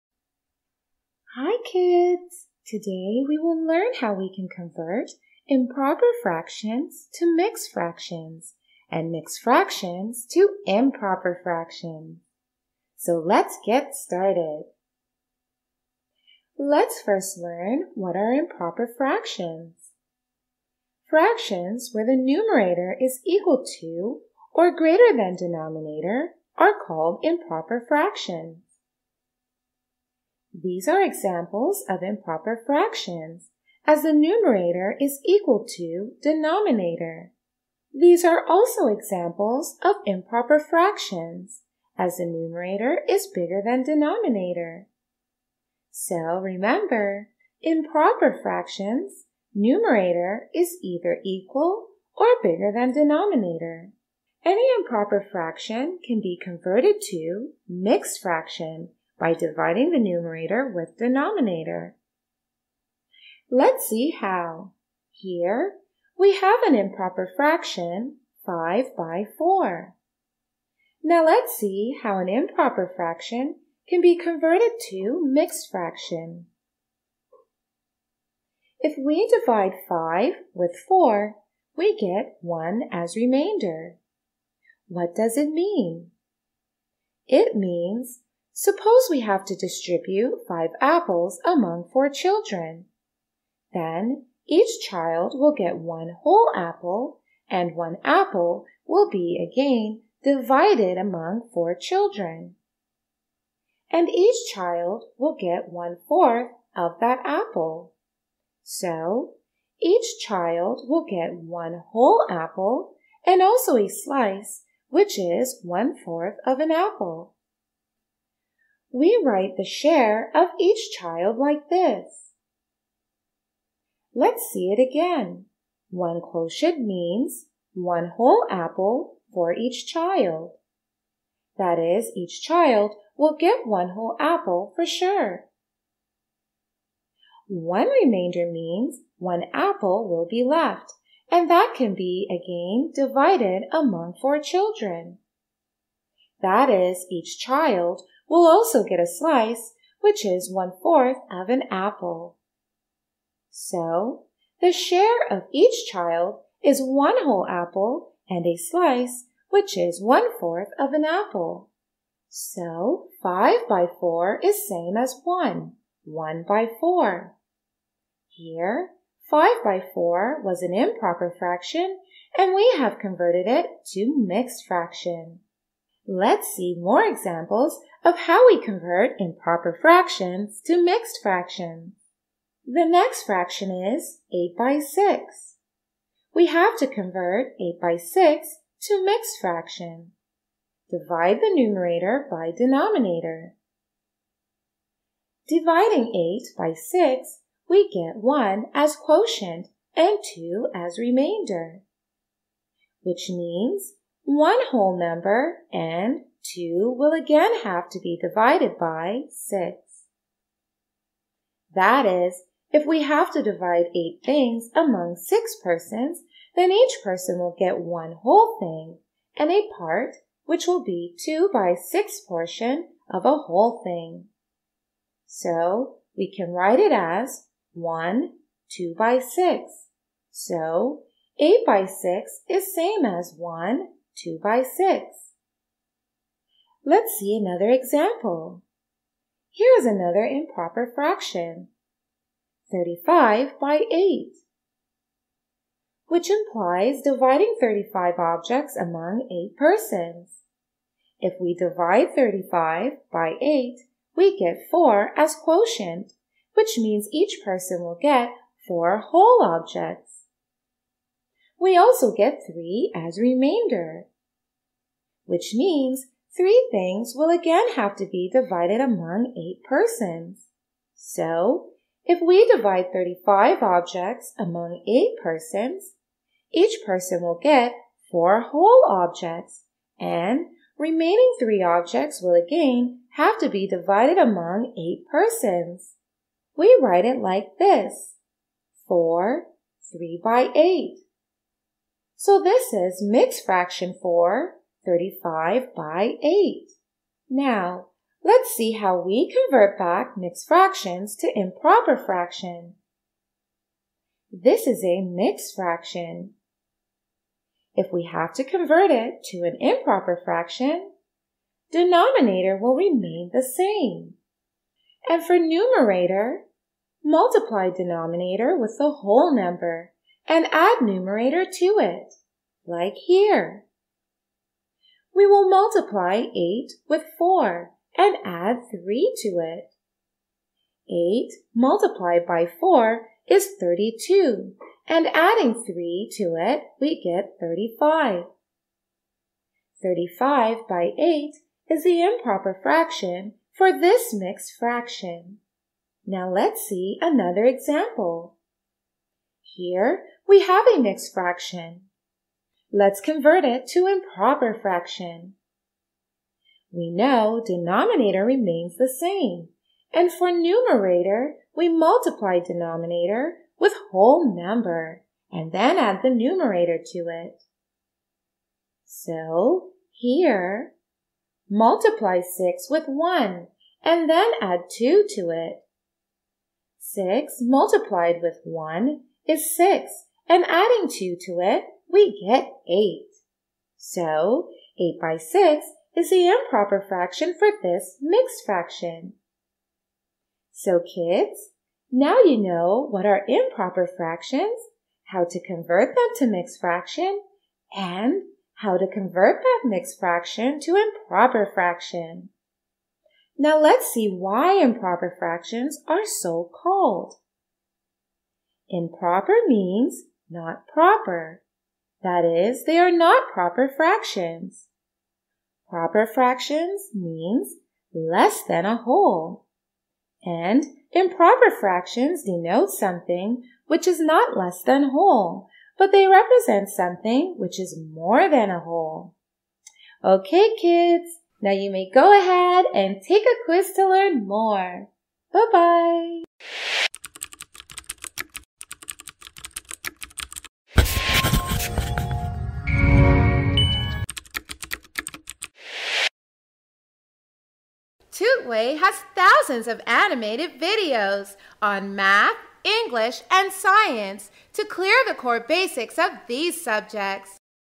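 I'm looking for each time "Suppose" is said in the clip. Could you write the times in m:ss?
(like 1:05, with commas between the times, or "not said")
1:28.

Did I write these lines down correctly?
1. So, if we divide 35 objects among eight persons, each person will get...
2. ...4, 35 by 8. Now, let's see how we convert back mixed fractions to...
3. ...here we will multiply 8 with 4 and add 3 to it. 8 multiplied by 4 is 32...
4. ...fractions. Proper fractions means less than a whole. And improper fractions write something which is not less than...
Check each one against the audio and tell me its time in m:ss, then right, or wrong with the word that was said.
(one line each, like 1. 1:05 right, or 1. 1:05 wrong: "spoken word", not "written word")
1. 4:30 right
2. 4:54 right
3. 5:23 right
4. 6:53 wrong: "denote", not "write".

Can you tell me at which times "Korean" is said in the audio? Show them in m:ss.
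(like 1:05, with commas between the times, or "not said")
not said.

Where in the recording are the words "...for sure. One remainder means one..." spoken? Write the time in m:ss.
2:14.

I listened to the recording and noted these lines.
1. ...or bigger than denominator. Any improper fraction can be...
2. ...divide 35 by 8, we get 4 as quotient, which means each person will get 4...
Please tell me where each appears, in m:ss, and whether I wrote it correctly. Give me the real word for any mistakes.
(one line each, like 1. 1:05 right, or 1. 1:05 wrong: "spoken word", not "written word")
1. 0:52 right
2. 4:11 right.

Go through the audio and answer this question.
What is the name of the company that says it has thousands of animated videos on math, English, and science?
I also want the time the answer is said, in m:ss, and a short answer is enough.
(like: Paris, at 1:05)
Tutway, at 7:28.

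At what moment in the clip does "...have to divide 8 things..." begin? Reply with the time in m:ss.
3:33.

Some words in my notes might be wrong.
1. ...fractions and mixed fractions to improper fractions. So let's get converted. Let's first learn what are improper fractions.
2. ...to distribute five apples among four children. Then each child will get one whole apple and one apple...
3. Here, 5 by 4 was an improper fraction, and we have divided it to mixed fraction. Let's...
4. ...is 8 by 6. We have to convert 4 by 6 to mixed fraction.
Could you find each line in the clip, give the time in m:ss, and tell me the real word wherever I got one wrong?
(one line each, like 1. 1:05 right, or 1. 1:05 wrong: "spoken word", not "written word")
1. 0:07 wrong: "started", not "converted"
2. 1:29 right
3. 2:48 wrong: "converted", not "divided"
4. 3:03 wrong: "8", not "4".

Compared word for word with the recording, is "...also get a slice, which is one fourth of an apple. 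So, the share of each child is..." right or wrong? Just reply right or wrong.
right.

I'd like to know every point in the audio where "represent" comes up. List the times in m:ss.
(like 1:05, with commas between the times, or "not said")
7:06.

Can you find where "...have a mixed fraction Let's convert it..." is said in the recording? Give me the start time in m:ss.
5:50.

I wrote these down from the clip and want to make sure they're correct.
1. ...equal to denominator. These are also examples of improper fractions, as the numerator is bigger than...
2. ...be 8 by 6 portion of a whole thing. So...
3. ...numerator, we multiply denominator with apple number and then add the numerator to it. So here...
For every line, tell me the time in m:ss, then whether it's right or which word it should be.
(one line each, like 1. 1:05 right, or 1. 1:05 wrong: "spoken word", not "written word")
1. 0:35 right
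2. 3:40 wrong: "2", not "8"
3. 6:00 wrong: "whole", not "apple".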